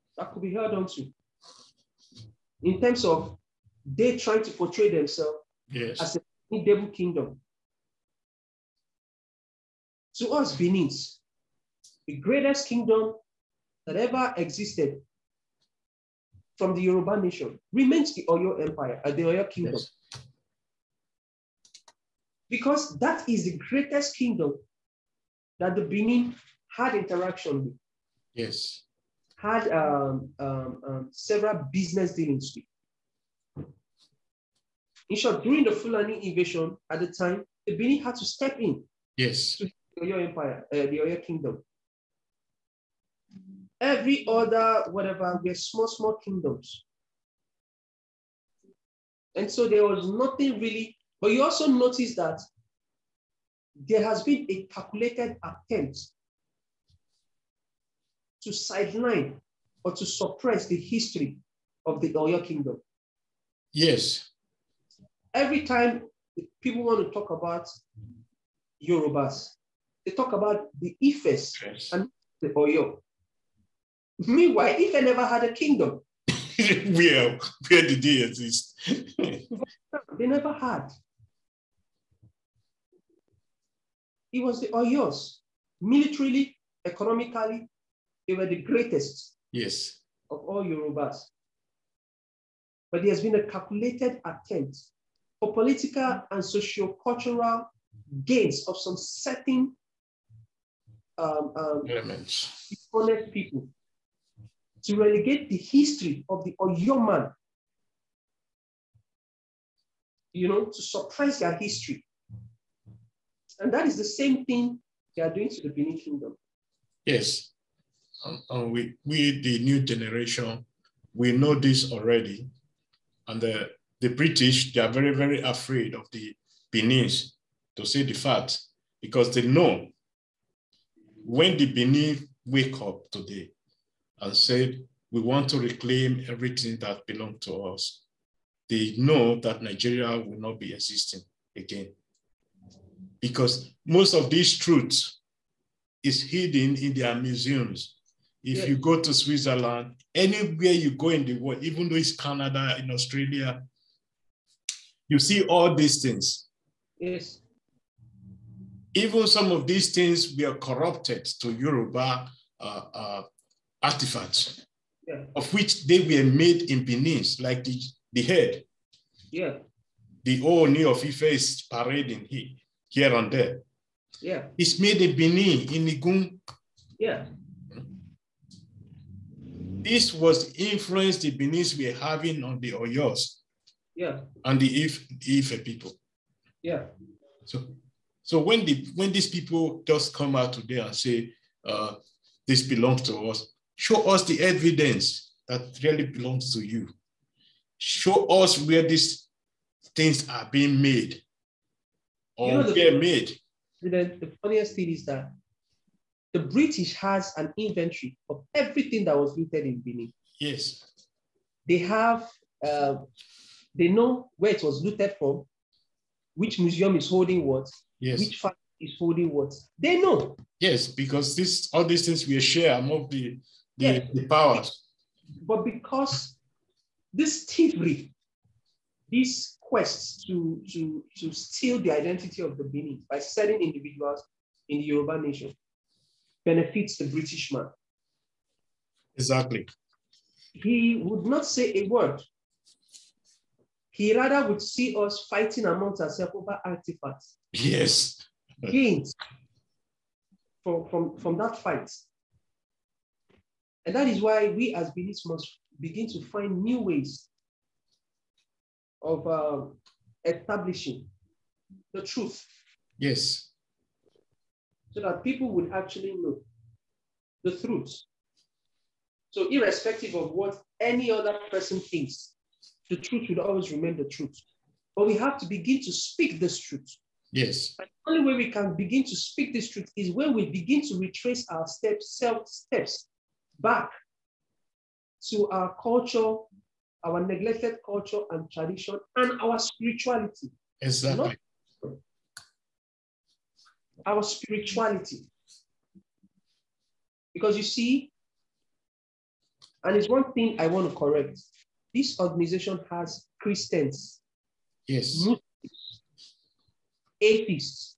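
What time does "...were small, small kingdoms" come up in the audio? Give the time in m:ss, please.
0:45.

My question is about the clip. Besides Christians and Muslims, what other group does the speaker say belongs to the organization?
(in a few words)
atheists.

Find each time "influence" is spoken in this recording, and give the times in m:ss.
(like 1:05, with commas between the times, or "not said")
3:00.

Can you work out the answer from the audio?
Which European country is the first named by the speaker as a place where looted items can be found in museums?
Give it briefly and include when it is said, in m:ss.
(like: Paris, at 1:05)
Switzerland, at 2:29.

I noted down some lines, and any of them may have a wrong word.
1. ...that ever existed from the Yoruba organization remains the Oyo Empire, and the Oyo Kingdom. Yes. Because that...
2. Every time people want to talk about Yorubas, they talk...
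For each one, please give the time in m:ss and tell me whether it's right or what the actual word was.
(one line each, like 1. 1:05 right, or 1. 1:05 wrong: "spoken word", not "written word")
1. 0:13 wrong: "nation", not "organization"
2. 1:05 right.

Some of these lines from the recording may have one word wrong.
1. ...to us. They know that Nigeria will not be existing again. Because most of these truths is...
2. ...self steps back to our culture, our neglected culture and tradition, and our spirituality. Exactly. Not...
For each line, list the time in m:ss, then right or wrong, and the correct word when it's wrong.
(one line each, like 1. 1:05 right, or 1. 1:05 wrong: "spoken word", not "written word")
1. 2:17 right
2. 4:42 right.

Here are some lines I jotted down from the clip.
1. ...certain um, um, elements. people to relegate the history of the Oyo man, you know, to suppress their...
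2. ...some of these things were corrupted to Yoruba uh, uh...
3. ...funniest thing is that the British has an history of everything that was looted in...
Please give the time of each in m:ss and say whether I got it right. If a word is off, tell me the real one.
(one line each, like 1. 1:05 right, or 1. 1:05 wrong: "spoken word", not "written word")
1. 1:38 right
2. 2:39 right
3. 3:24 wrong: "inventory", not "history".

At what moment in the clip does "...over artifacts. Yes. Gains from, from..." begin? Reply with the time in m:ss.
4:06.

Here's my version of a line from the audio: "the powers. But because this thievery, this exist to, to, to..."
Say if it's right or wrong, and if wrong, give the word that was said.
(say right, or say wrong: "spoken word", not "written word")
wrong: "quest", not "exist".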